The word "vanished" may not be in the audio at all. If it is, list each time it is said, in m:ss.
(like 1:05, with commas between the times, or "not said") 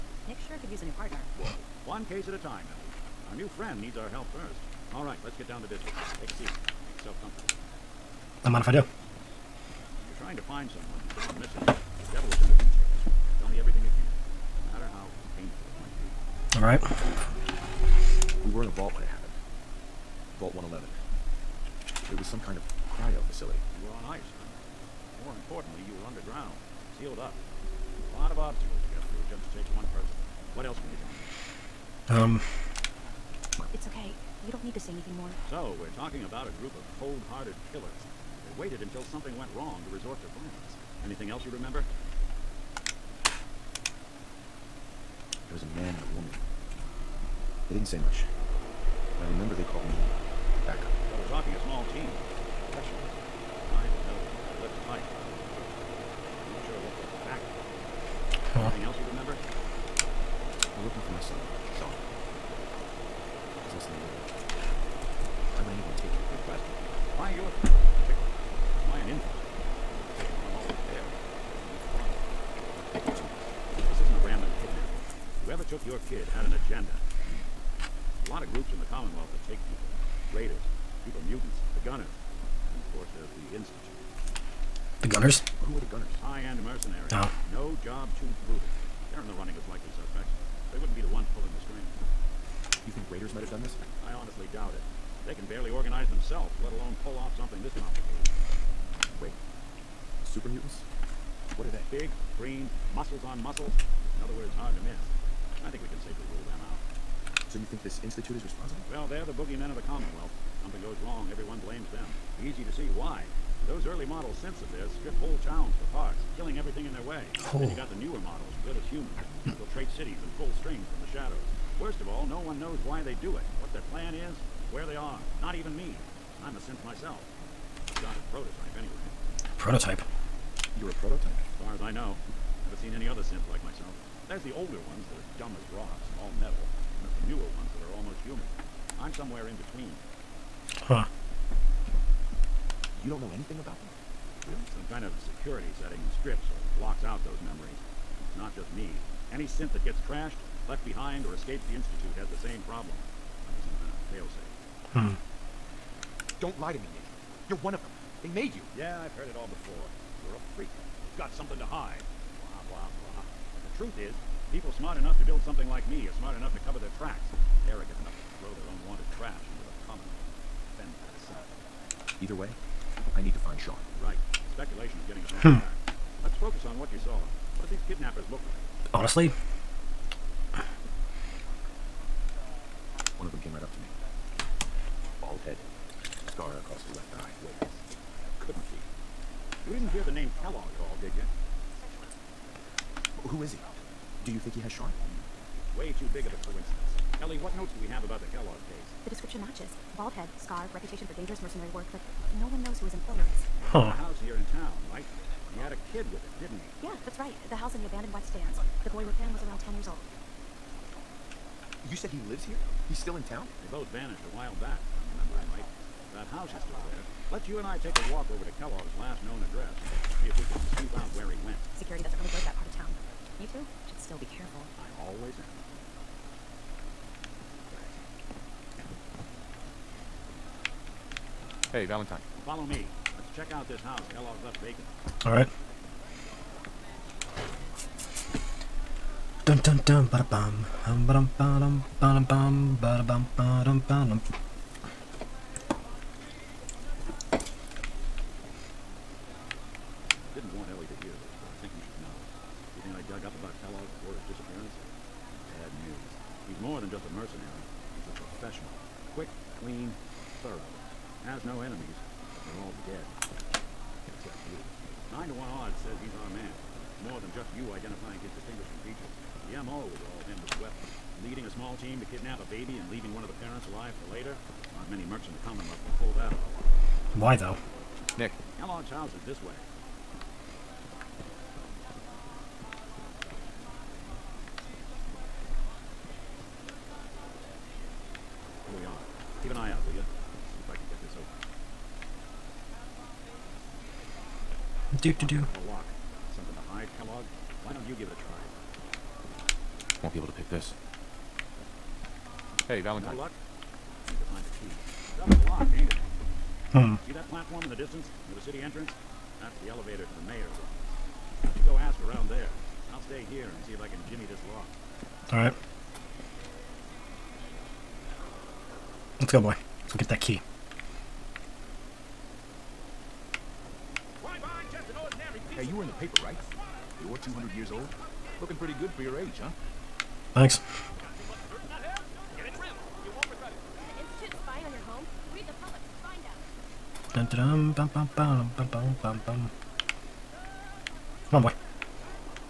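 3:33.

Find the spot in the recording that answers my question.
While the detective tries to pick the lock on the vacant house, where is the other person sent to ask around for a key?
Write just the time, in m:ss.
5:10.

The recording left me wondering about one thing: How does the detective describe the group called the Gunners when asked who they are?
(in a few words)
High-end mercenaries.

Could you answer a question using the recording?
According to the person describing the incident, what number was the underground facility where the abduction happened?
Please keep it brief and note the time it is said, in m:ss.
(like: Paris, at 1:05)
111, at 0:20.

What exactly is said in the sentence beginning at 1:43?
In other words, hard to miss.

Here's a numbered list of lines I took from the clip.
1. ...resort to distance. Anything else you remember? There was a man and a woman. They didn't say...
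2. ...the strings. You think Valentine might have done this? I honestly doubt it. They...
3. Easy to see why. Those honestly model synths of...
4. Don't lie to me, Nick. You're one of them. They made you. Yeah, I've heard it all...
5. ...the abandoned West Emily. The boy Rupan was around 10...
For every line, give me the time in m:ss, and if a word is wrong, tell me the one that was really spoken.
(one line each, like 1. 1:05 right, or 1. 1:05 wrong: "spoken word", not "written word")
1. 0:39 wrong: "violence", not "distance"
2. 1:31 wrong: "Raiders", not "Valentine"
3. 1:52 wrong: "early", not "honestly"
4. 2:36 right
5. 3:27 wrong: "Stands", not "Emily".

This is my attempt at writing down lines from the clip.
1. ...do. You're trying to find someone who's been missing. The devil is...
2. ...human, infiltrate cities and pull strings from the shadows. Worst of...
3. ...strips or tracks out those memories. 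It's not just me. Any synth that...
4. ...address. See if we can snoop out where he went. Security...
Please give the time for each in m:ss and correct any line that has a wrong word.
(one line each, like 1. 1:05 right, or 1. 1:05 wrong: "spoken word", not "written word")
1. 0:08 right
2. 1:58 right
3. 2:26 wrong: "blocks", not "tracks"
4. 3:39 right.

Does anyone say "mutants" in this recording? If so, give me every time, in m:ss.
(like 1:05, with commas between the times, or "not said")
1:21, 1:40.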